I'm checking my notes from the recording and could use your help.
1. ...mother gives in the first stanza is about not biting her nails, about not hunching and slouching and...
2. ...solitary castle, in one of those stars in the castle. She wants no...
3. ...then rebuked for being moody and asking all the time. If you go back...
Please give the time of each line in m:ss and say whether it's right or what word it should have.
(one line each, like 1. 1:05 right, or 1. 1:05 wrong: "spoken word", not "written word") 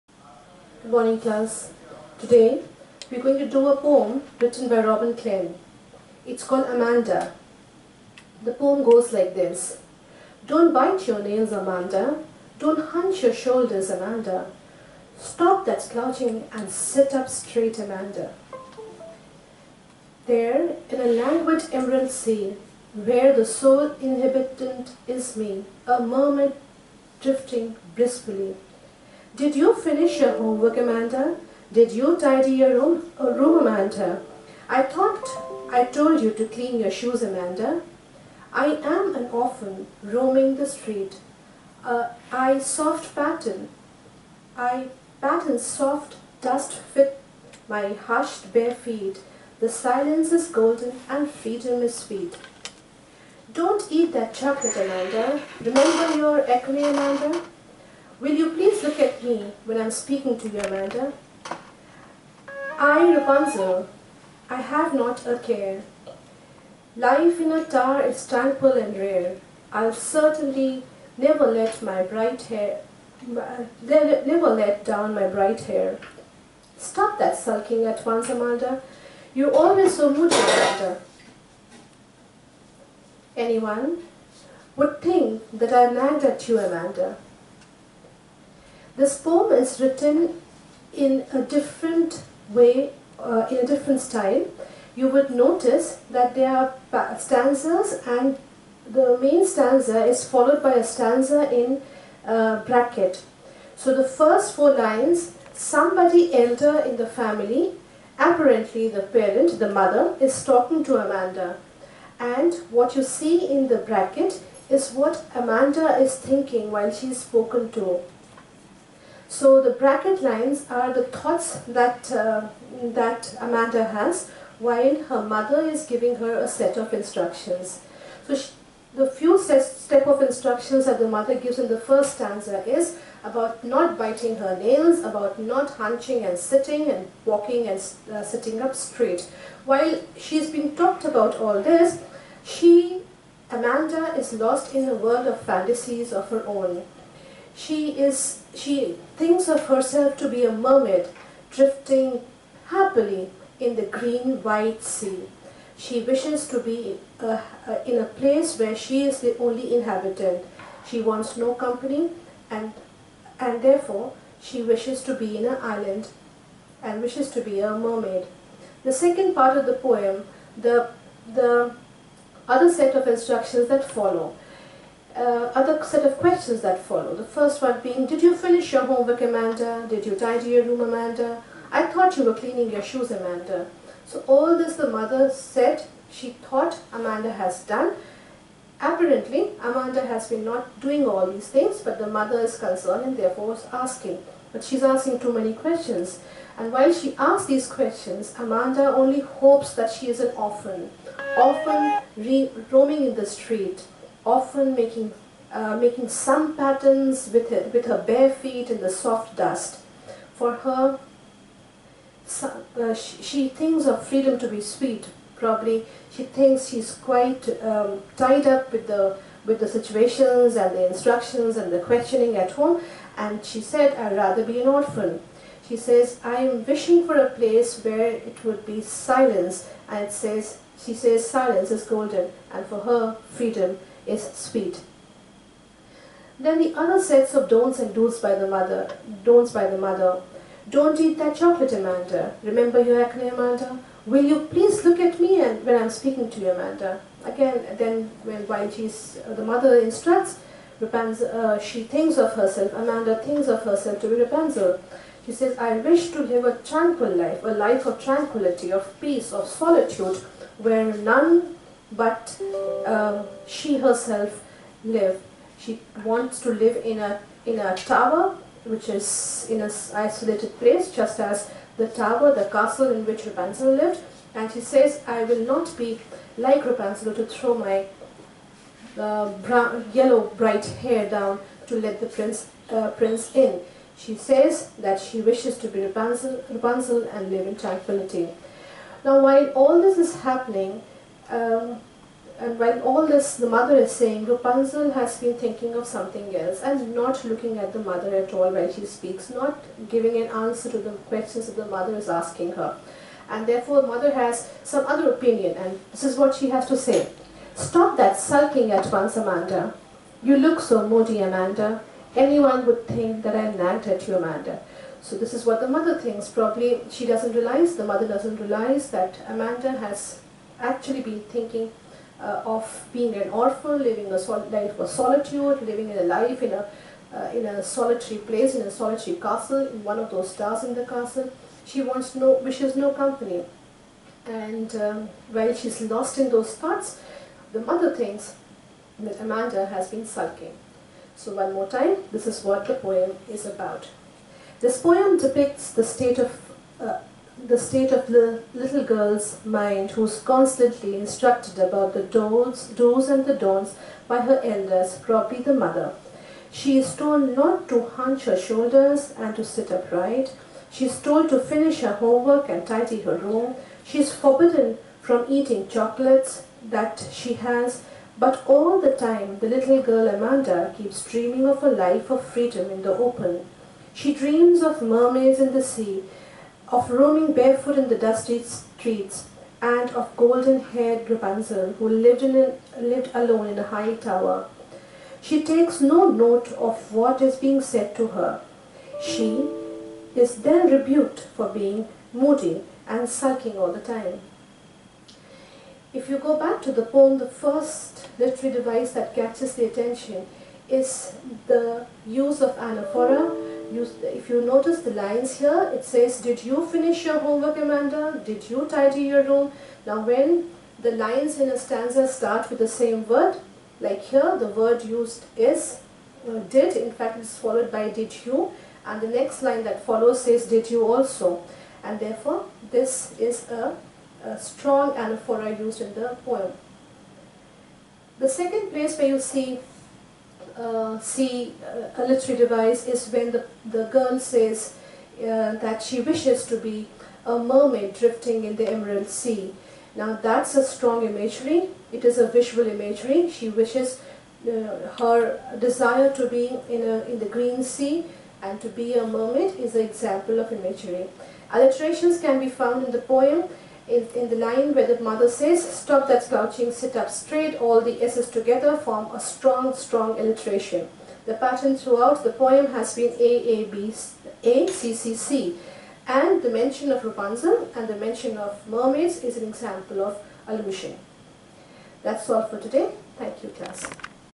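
1. 2:11 wrong: "sitting", not "slouching"
2. 5:28 right
3. 6:30 wrong: "sulking", not "asking".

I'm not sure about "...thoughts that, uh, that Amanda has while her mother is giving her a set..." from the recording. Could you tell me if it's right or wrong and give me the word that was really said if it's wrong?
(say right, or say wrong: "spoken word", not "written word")
right.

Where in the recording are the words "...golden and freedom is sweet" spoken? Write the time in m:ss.
0:50.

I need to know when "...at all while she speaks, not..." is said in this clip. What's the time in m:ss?
4:58.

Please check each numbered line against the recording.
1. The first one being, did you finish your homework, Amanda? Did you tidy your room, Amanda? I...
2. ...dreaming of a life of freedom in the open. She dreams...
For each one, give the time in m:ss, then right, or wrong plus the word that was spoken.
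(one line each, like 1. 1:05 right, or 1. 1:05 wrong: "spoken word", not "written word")
1. 2:57 right
2. 6:11 right.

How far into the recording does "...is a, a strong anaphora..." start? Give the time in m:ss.
7:03.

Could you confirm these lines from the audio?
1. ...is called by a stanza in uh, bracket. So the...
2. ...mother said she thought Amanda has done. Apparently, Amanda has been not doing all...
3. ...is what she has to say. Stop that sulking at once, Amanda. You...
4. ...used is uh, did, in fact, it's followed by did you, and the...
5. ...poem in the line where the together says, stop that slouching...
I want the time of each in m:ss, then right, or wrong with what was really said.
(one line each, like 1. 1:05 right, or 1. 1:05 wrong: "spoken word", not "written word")
1. 1:40 wrong: "followed", not "called"
2. 3:04 right
3. 5:06 right
4. 6:54 right
5. 7:32 wrong: "mother", not "together".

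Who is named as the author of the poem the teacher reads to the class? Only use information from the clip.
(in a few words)
Robin Klein.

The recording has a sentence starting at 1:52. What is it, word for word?
And what you see in the bracket is what Amanda is thinking while she's spoken to.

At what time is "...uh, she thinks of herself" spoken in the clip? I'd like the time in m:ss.
4:11.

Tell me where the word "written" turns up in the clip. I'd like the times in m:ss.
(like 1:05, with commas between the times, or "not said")
0:04, 1:29.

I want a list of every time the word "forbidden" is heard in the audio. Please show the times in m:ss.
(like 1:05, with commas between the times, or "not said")
6:04.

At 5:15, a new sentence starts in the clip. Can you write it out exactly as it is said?
So this is what the mother thinks.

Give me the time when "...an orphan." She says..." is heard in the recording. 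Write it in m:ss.
3:44.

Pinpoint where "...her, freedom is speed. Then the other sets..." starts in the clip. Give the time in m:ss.
3:52.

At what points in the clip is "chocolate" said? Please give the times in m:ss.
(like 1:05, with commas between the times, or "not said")
0:54, 4:01, 6:05.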